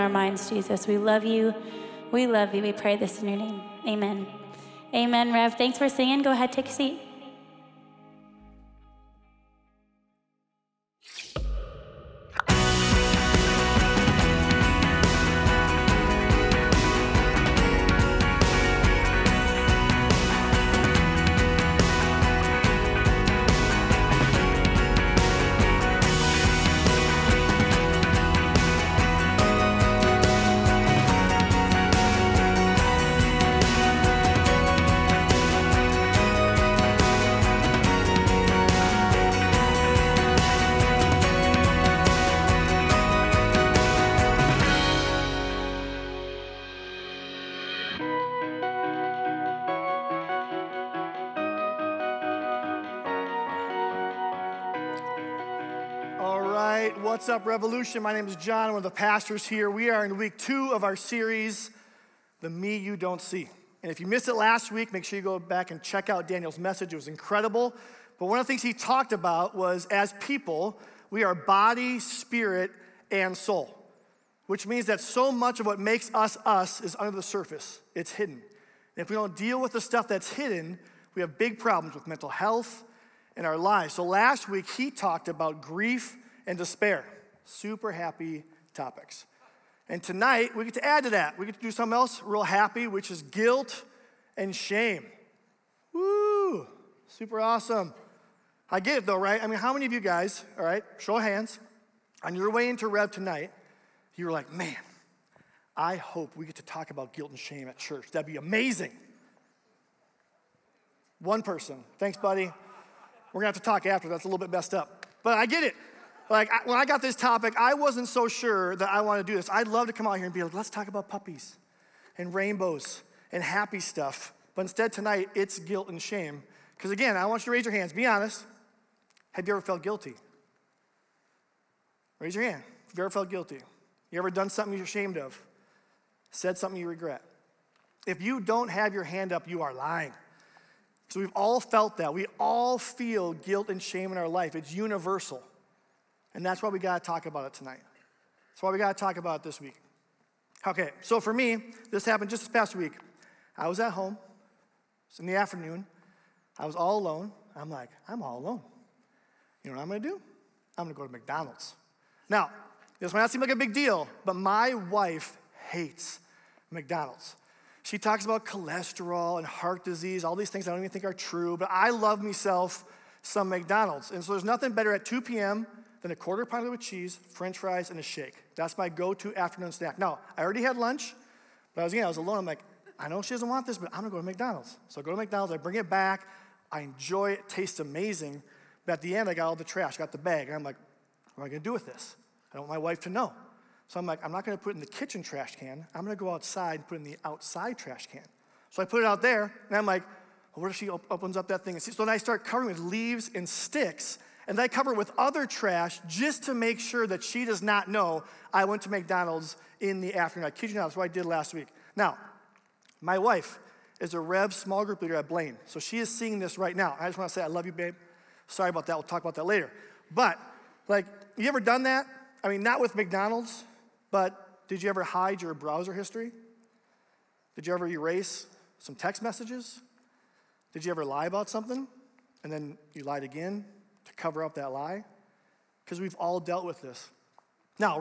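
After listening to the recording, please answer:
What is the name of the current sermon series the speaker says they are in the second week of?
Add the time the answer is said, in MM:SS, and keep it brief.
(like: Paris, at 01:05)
The Me You Don't See, at 01:02.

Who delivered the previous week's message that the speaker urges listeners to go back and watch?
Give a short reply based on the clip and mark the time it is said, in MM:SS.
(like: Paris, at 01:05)
Daniel, at 01:06.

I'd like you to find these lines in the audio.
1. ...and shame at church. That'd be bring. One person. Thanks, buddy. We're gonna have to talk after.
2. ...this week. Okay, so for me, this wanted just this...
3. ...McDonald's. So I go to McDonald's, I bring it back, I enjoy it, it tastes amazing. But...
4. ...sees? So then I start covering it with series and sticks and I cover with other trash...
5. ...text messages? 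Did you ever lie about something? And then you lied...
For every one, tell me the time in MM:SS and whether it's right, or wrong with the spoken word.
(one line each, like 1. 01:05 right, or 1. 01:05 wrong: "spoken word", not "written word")
1. 01:47 wrong: "amazing", not "bring"
2. 02:29 wrong: "happened", not "wanted"
3. 03:04 right
4. 03:21 wrong: "leaves", not "series"
5. 03:48 right.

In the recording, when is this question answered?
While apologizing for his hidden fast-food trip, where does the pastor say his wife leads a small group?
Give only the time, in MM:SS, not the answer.
03:35.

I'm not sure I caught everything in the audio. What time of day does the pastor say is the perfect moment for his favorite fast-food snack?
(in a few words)
2 p.m.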